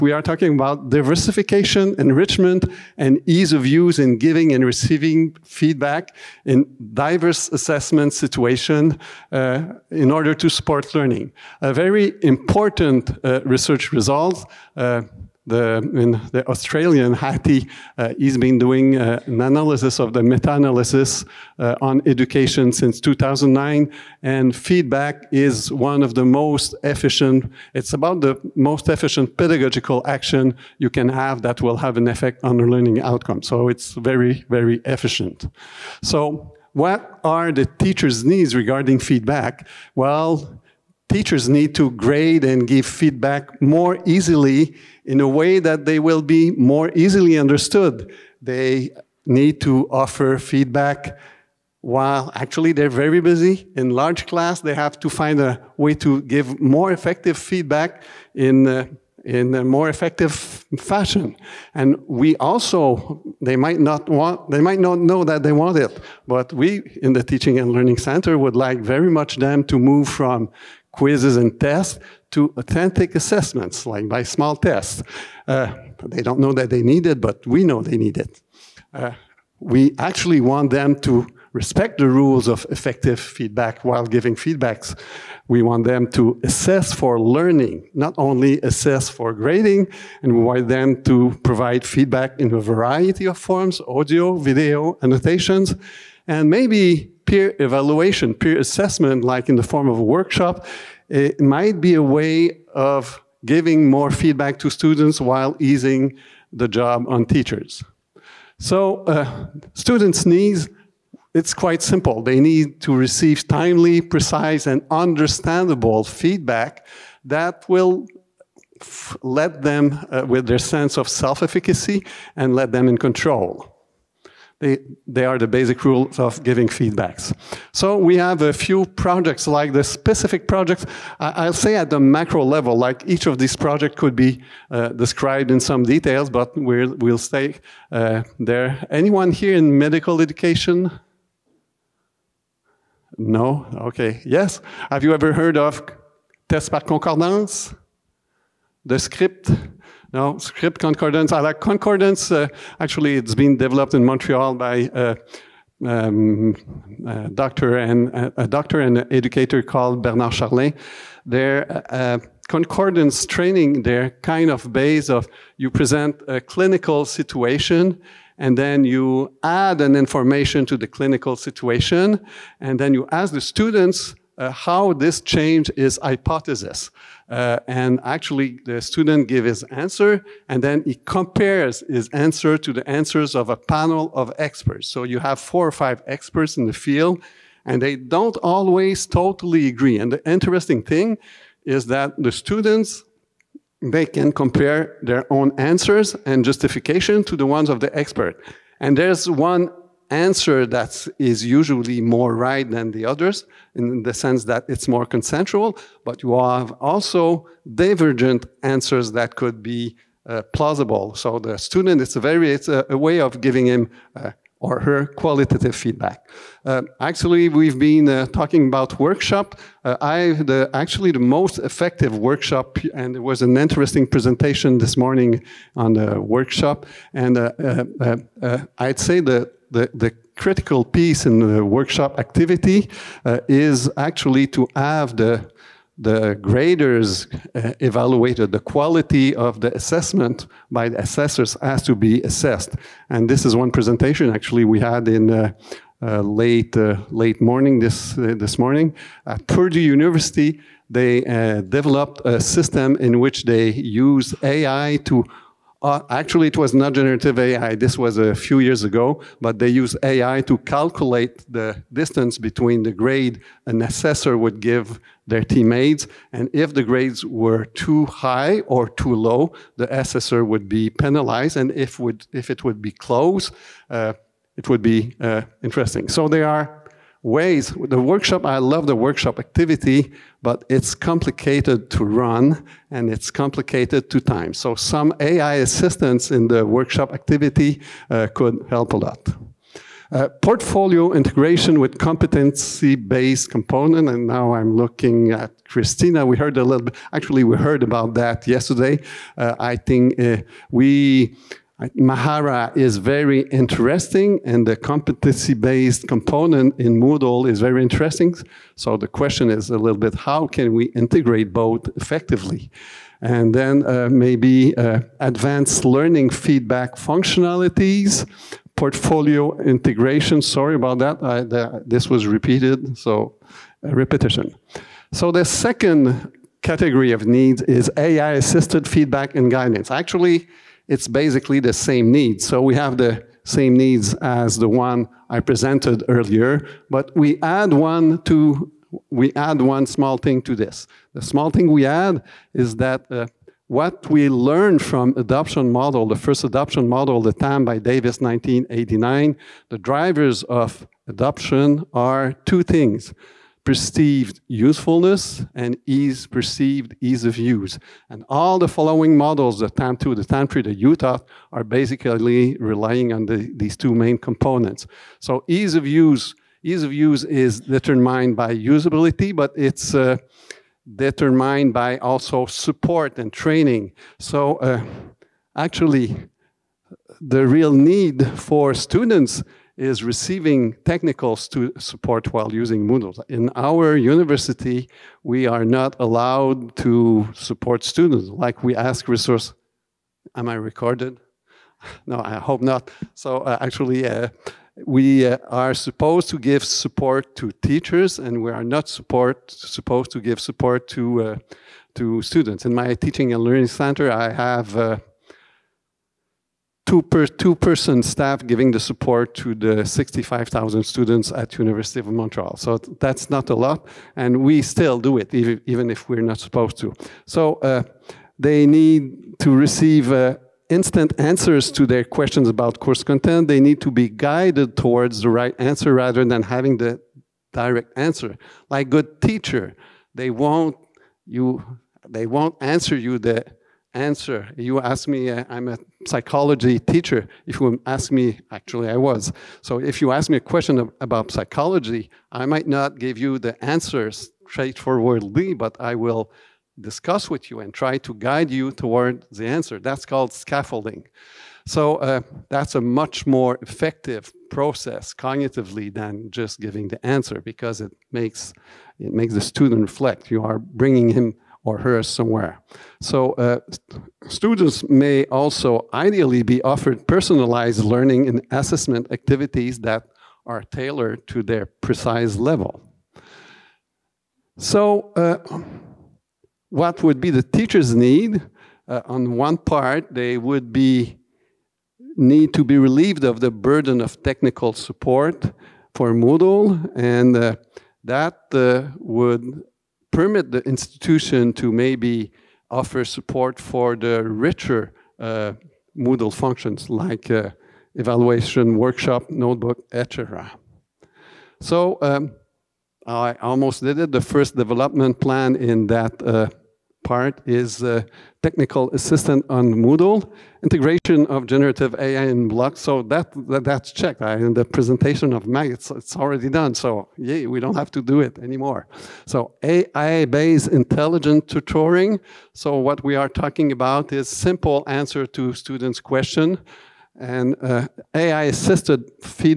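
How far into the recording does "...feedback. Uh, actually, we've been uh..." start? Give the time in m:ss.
3:35.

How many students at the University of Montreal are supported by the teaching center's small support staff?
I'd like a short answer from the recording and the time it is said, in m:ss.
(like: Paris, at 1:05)
65,000, at 6:49.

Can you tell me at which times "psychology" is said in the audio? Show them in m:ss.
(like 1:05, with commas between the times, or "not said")
7:16, 7:21.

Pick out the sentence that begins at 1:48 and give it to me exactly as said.
So uh, students' needs, it's quite simple.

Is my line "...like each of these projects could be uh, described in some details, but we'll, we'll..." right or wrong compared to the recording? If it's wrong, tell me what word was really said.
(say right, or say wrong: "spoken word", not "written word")
right.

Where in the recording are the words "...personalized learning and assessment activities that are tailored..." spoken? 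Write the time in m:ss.
7:47.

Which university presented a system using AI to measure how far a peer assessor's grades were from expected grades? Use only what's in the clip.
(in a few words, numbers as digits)
Purdue University.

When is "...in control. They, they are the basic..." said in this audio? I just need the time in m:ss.
2:02.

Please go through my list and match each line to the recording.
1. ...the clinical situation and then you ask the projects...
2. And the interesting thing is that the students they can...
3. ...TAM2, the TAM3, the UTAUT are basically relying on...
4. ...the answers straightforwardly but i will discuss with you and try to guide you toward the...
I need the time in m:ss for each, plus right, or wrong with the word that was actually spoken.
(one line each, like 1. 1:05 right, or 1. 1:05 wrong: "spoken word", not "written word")
1. 2:50 wrong: "students", not "projects"
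2. 3:09 right
3. 5:59 right
4. 7:23 right.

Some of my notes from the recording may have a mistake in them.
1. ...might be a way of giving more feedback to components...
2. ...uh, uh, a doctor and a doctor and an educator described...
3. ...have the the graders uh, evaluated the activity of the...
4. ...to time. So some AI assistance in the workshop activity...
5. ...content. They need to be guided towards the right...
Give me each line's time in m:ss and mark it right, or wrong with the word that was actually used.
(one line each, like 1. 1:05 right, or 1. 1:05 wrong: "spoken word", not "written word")
1. 1:41 wrong: "students", not "components"
2. 2:37 wrong: "called", not "described"
3. 3:54 wrong: "quality", not "activity"
4. 4:44 right
5. 7:03 right.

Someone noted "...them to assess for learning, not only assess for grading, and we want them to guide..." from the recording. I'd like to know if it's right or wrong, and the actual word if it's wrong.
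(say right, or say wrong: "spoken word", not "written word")
wrong: "provide", not "guide".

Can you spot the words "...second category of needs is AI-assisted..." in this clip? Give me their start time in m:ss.
5:25.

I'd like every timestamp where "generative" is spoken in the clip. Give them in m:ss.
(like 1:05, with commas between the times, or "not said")
4:16, 8:31.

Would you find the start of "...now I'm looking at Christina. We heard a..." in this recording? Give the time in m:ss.
4:54.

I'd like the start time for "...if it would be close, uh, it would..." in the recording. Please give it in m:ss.
4:32.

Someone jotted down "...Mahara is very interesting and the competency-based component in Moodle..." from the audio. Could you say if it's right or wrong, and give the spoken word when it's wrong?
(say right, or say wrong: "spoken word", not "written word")
right.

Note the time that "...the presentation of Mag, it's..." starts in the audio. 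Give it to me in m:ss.
8:34.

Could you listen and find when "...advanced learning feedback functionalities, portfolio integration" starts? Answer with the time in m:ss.
5:15.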